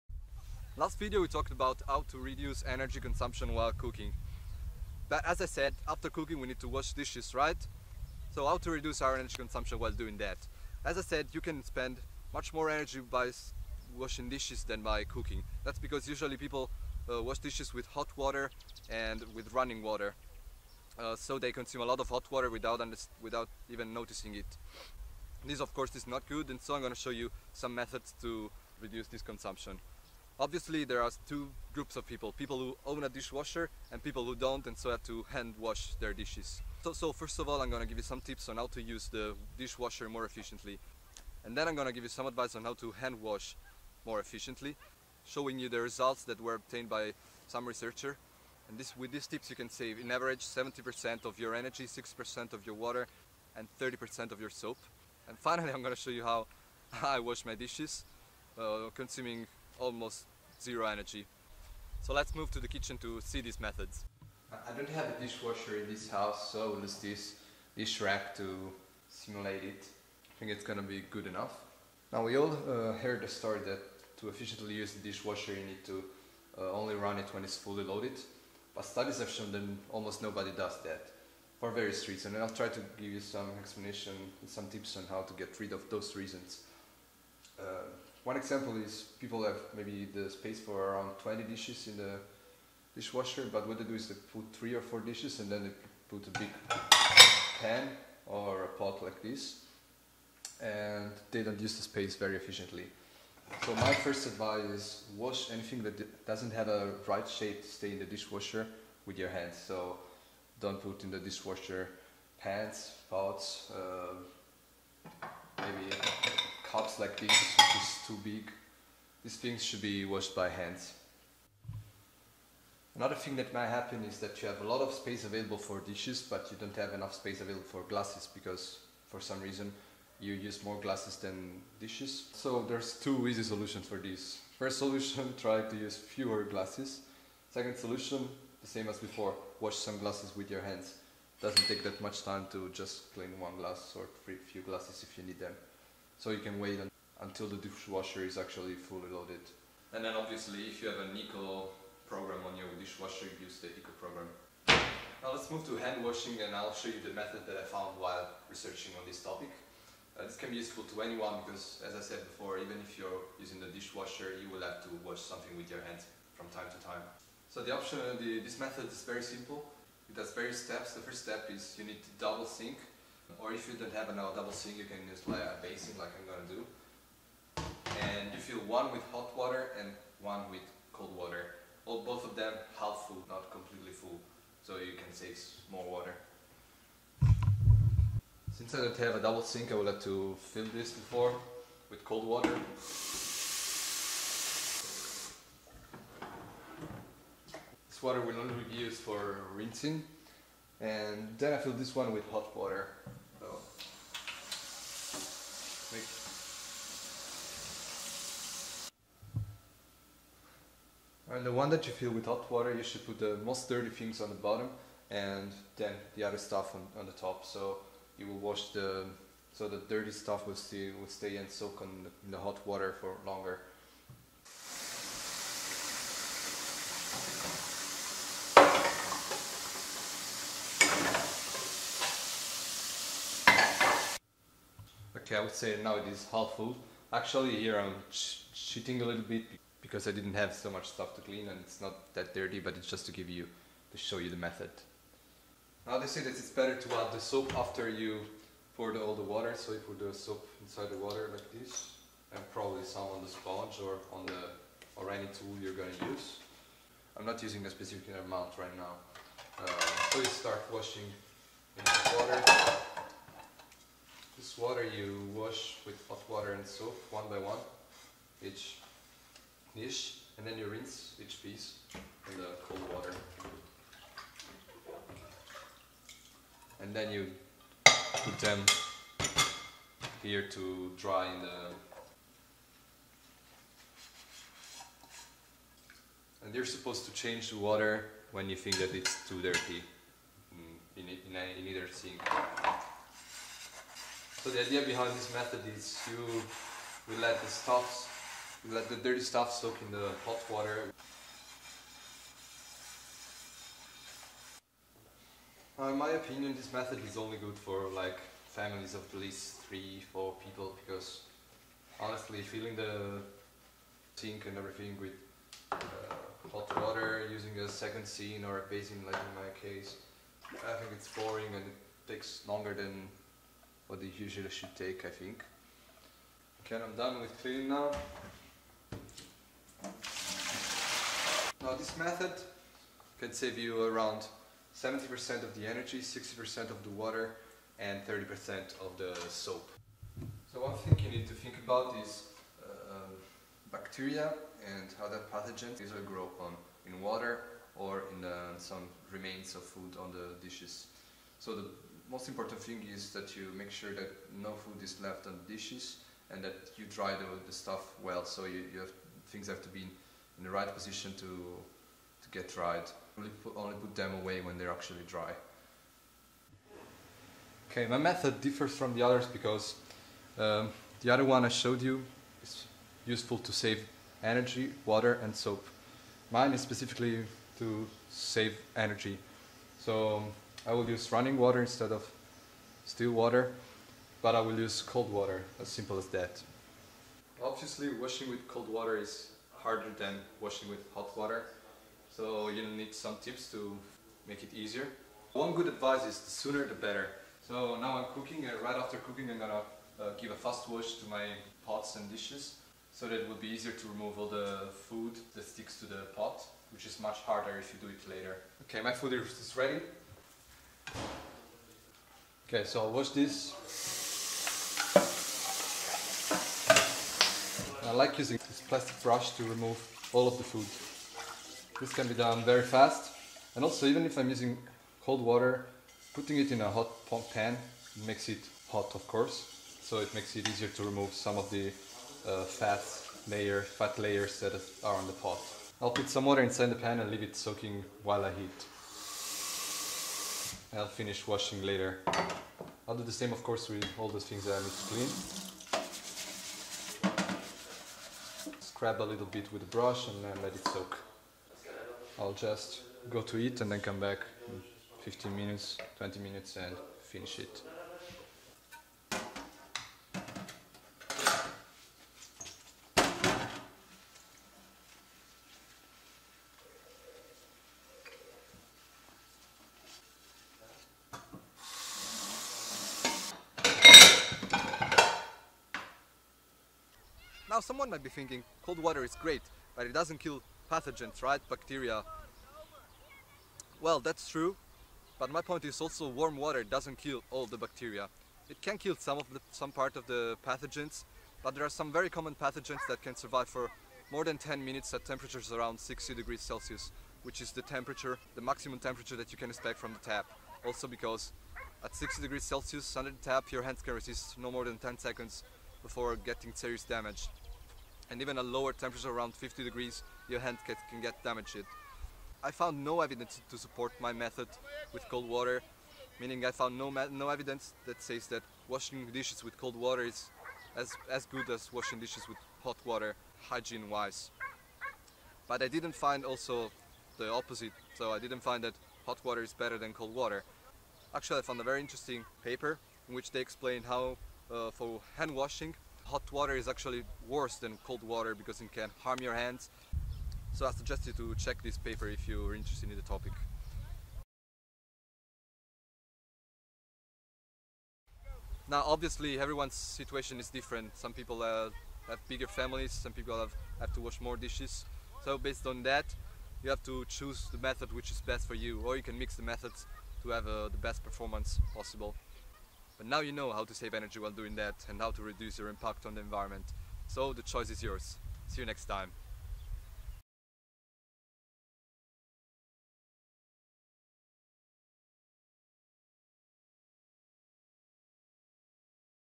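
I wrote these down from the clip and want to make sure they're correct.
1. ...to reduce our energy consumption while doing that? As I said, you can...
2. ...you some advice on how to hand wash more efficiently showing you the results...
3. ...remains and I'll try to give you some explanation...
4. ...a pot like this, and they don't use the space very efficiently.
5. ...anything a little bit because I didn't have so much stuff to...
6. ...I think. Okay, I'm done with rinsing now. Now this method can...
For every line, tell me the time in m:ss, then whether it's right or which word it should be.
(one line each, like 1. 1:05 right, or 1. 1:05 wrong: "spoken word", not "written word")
1. 0:08 right
2. 0:42 right
3. 1:22 wrong: "reasons", not "remains"
4. 1:38 right
5. 3:58 wrong: "cheating", not "anything"
6. 5:25 wrong: "cleaning", not "rinsing".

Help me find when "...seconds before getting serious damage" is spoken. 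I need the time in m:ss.
8:24.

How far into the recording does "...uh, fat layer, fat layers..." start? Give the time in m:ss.
7:12.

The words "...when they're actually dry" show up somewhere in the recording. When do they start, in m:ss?
6:04.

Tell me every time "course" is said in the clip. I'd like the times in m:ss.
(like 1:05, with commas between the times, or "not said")
0:25, 7:09, 7:23.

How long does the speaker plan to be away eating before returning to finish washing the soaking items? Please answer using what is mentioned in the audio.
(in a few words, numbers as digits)
15 to 20 minutes.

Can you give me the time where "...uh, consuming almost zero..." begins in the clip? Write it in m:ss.
0:58.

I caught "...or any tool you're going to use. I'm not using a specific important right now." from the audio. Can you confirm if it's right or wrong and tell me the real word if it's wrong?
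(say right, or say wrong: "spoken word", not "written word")
wrong: "amount", not "important".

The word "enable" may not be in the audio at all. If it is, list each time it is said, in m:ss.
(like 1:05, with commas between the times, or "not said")
not said.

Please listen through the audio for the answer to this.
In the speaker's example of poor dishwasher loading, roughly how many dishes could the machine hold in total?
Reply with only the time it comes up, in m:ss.
1:30.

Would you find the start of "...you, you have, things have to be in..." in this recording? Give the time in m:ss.
5:58.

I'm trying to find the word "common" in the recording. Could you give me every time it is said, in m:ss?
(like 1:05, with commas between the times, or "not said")
8:12.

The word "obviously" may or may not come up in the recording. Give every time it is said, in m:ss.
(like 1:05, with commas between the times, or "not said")
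0:30, 2:30, 6:27, 9:08.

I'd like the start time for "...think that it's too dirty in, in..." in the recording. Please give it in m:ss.
4:48.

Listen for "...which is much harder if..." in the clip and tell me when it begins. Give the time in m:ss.
6:46.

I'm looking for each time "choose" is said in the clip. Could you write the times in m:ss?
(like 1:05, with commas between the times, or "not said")
9:17.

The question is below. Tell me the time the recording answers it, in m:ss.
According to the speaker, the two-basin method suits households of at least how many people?
5:09.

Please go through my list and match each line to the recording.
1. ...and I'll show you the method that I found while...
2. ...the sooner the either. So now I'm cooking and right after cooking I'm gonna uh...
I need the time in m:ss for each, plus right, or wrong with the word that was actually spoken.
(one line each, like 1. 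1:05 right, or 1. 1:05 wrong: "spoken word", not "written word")
1. 2:36 right
2. 6:36 wrong: "better", not "either".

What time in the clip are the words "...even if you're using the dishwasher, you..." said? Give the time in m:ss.
2:42.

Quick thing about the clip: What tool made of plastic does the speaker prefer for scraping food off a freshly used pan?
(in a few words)
Plastic brush.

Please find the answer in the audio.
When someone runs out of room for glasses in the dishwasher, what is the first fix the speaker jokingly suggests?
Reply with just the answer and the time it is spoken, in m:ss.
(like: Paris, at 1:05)
Use fewer glasses, at 2:15.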